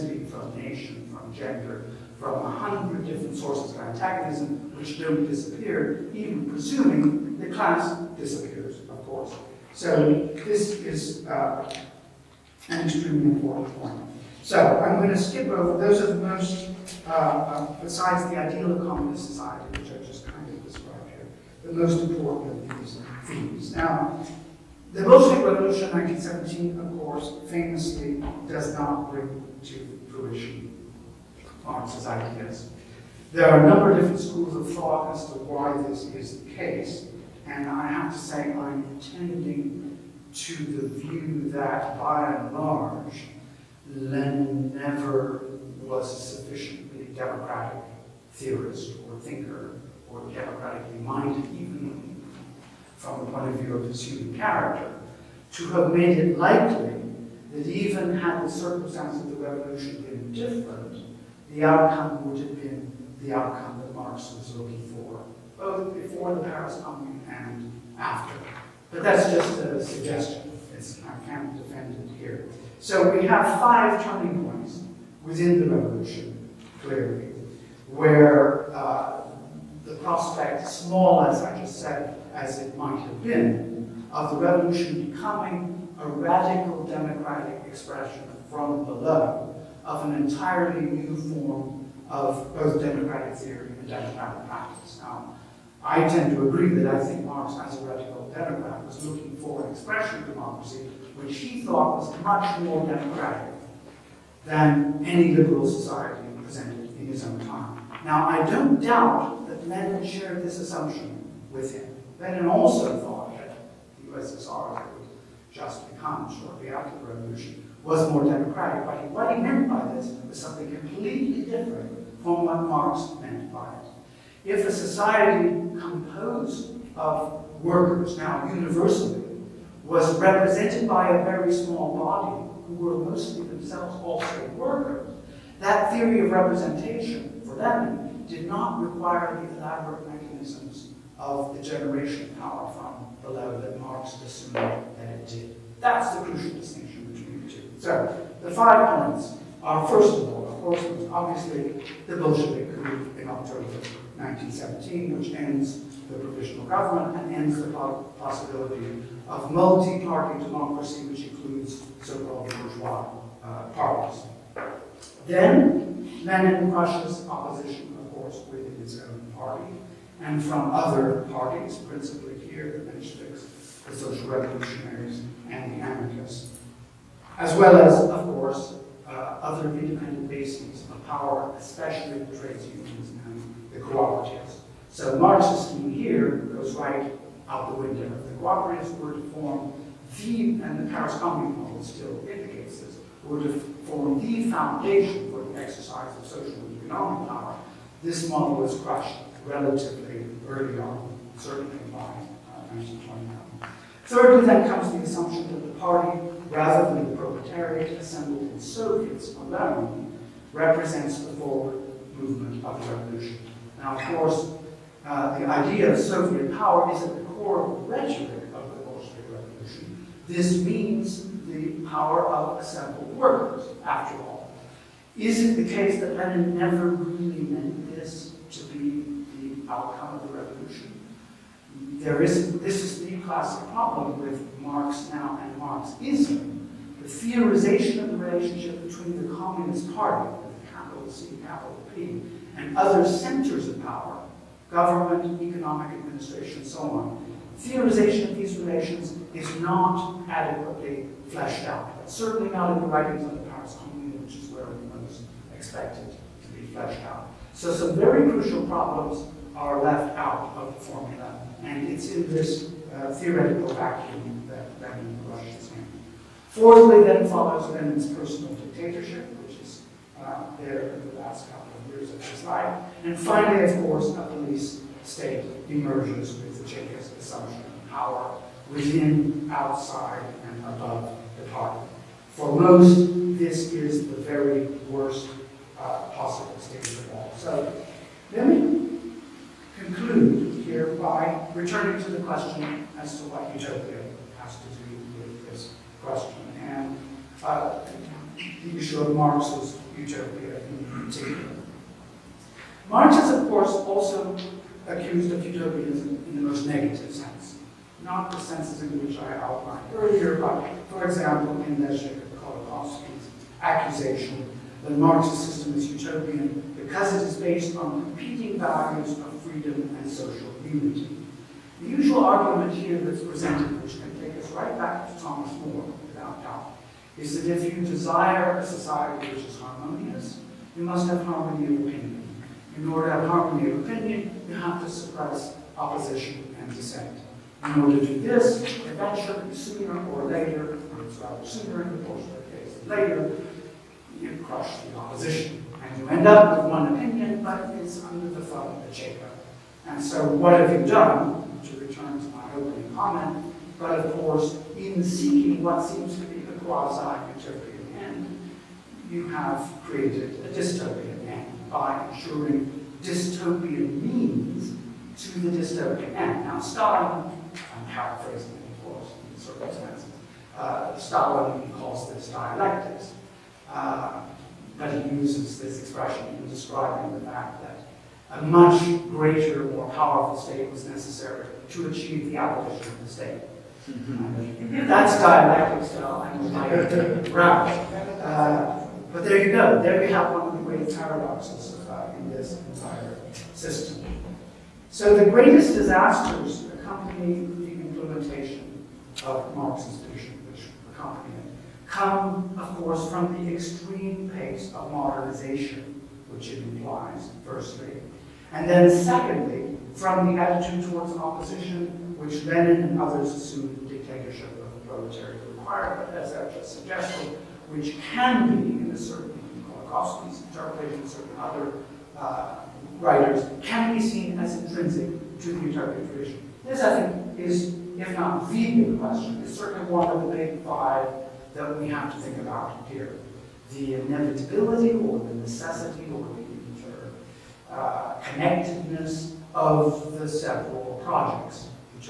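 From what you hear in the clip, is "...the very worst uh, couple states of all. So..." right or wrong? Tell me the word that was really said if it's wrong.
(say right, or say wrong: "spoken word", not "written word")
wrong: "possible", not "couple".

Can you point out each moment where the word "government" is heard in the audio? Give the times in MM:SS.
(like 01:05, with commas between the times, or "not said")
02:36, 04:04.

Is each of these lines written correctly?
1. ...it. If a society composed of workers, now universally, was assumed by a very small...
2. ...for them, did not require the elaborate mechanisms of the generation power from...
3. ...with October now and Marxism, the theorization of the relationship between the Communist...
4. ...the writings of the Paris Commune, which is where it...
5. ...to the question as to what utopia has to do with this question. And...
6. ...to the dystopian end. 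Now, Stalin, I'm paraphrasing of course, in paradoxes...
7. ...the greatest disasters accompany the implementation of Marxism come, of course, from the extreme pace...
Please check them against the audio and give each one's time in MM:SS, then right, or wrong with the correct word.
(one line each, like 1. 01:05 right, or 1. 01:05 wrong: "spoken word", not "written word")
1. 02:03 wrong: "represented", not "assumed"
2. 02:17 right
3. 03:54 wrong: "Marx", not "October"
4. 04:12 right
5. 04:52 right
6. 06:05 wrong: "circumstances", not "paradoxes"
7. 06:35 right.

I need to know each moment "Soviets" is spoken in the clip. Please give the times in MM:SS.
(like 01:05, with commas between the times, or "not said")
03:28, 03:35.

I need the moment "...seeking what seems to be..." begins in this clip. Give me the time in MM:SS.
05:55.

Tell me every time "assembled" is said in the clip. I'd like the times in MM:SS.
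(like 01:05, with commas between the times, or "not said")
03:28, 03:42.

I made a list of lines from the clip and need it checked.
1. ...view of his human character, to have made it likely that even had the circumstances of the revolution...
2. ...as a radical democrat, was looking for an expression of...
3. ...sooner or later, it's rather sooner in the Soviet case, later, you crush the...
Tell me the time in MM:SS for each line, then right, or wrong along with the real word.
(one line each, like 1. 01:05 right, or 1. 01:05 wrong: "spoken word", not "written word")
1. 00:53 right
2. 01:37 right
3. 05:39 wrong: "Bolshevik", not "Soviet".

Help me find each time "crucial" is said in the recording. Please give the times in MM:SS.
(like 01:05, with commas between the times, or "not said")
02:26, 04:18.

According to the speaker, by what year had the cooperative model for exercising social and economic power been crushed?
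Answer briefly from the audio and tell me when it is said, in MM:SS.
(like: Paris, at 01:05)
1929, at 03:22.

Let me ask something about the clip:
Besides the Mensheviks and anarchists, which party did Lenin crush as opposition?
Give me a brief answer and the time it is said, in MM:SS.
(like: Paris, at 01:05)
Social Revolutionaries, at 02:53.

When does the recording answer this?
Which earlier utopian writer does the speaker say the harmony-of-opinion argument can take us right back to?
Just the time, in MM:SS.
05:25.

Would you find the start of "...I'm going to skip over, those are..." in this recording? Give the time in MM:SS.
00:14.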